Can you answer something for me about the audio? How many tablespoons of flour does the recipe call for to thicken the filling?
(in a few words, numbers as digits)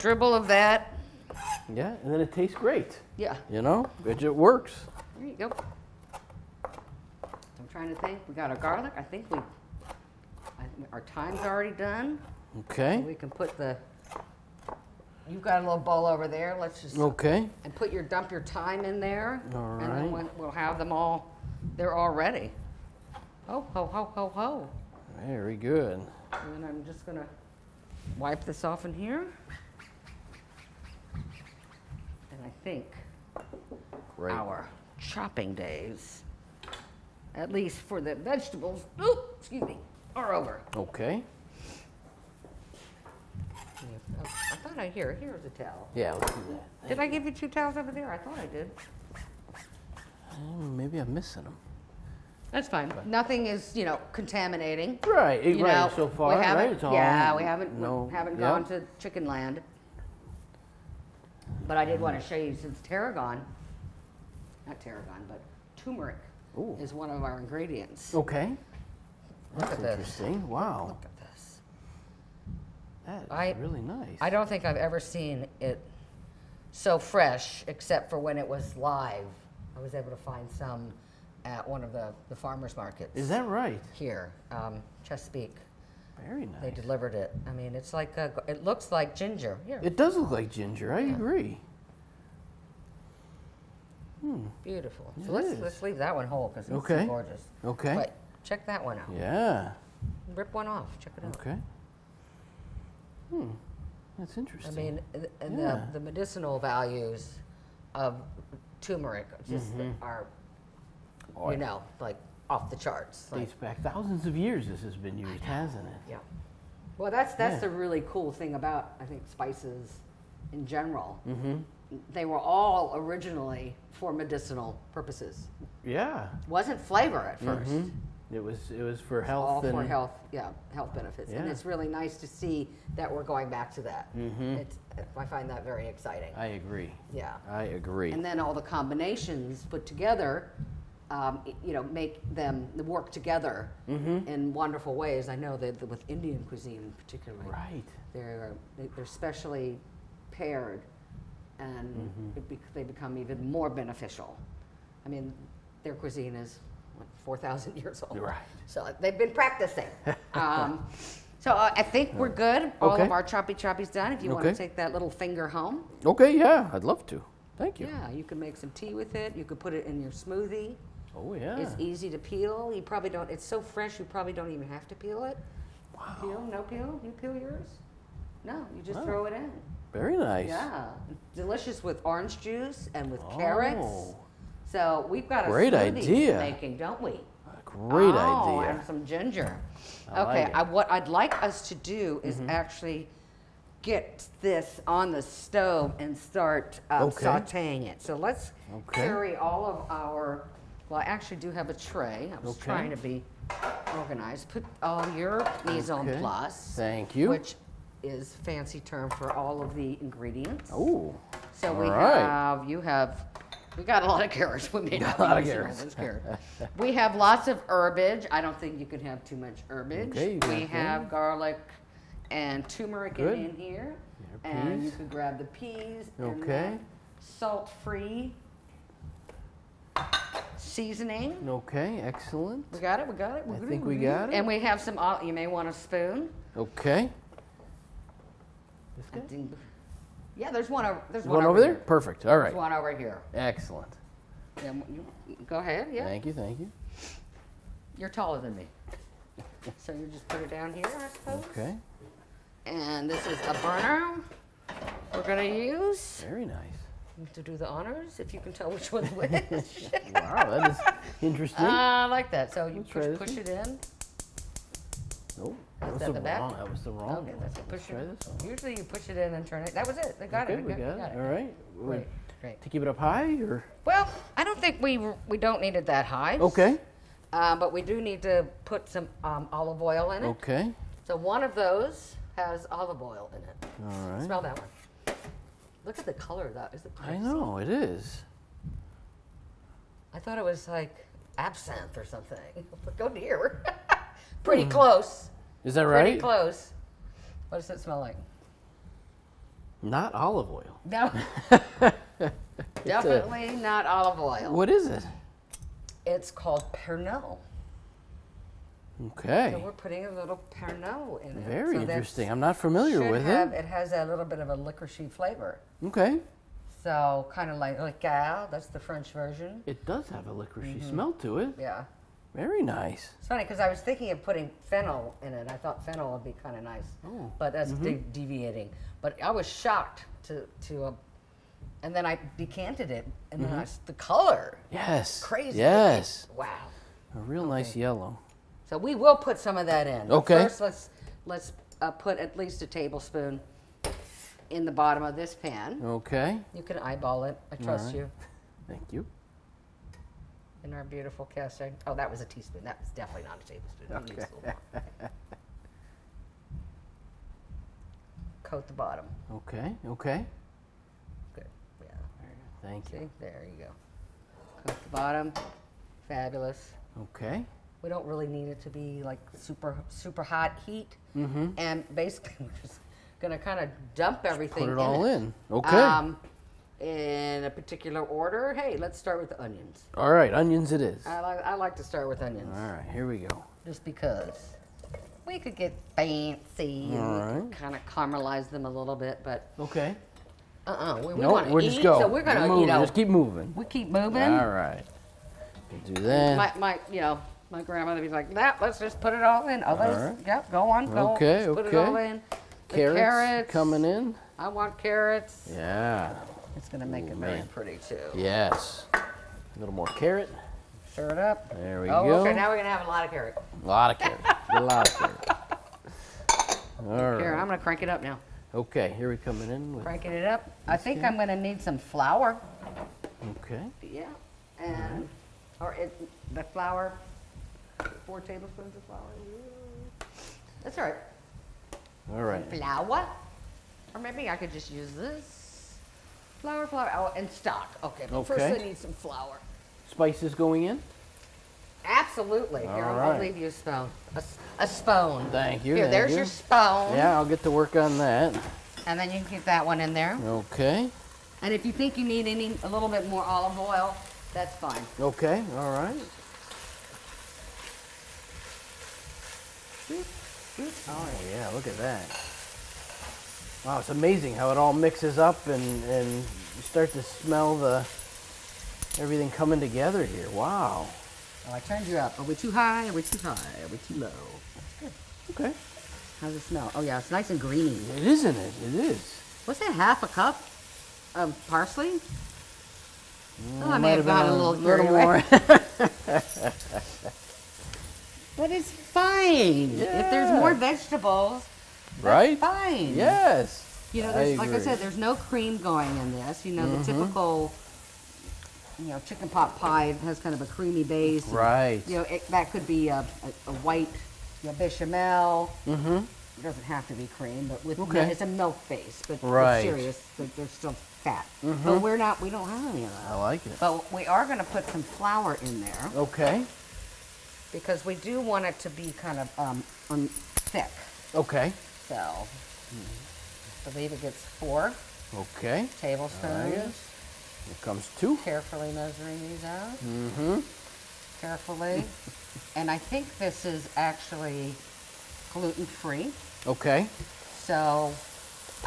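4.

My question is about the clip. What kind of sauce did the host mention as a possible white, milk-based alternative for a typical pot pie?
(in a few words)
bechamel.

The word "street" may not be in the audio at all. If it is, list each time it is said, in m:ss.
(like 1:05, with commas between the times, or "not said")
not said.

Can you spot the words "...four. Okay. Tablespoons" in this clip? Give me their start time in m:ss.
8:44.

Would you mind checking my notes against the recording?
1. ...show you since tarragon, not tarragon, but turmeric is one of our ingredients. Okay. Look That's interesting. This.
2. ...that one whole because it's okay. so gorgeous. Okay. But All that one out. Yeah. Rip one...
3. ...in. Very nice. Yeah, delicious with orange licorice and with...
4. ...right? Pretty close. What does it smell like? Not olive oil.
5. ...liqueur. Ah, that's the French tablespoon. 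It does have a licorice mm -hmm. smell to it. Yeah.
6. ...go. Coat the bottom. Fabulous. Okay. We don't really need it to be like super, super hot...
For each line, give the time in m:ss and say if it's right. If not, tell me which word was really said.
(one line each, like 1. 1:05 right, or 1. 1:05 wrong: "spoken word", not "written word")
1. 1:02 right
2. 1:35 wrong: "Check", not "All"
3. 2:59 wrong: "juice", not "licorice"
4. 4:55 right
5. 5:17 wrong: "version", not "tablespoon"
6. 6:03 right.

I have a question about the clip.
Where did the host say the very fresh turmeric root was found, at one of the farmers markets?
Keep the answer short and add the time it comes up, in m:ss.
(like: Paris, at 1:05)
Chesapeake, at 1:25.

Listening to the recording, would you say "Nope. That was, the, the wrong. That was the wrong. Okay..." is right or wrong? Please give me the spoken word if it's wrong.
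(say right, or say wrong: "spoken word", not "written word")
right.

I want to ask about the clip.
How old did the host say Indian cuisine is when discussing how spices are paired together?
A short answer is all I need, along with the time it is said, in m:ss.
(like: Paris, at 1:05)
4,000 years, at 2:37.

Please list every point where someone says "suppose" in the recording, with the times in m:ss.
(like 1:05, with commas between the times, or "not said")
4:11.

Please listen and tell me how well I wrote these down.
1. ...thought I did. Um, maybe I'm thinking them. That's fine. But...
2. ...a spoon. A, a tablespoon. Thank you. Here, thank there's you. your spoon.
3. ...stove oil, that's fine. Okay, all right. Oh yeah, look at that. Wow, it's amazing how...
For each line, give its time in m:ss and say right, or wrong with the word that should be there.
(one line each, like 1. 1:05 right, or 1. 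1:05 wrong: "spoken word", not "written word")
1. 0:48 wrong: "missing", not "thinking"
2. 7:23 wrong: "spoon", not "tablespoon"
3. 7:33 wrong: "olive", not "stove".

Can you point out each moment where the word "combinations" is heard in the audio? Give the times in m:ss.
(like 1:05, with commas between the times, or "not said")
2:18.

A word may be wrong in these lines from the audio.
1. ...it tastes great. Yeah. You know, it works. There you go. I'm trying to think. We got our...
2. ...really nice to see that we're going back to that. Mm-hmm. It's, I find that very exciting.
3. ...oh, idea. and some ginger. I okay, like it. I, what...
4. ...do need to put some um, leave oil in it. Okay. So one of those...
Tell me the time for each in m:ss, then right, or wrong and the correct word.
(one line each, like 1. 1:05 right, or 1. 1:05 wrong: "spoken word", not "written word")
1. 0:02 right
2. 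2:11 right
3. 3:08 right
4. 4:37 wrong: "olive", not "leave".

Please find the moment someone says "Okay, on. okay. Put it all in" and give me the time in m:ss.
6:41.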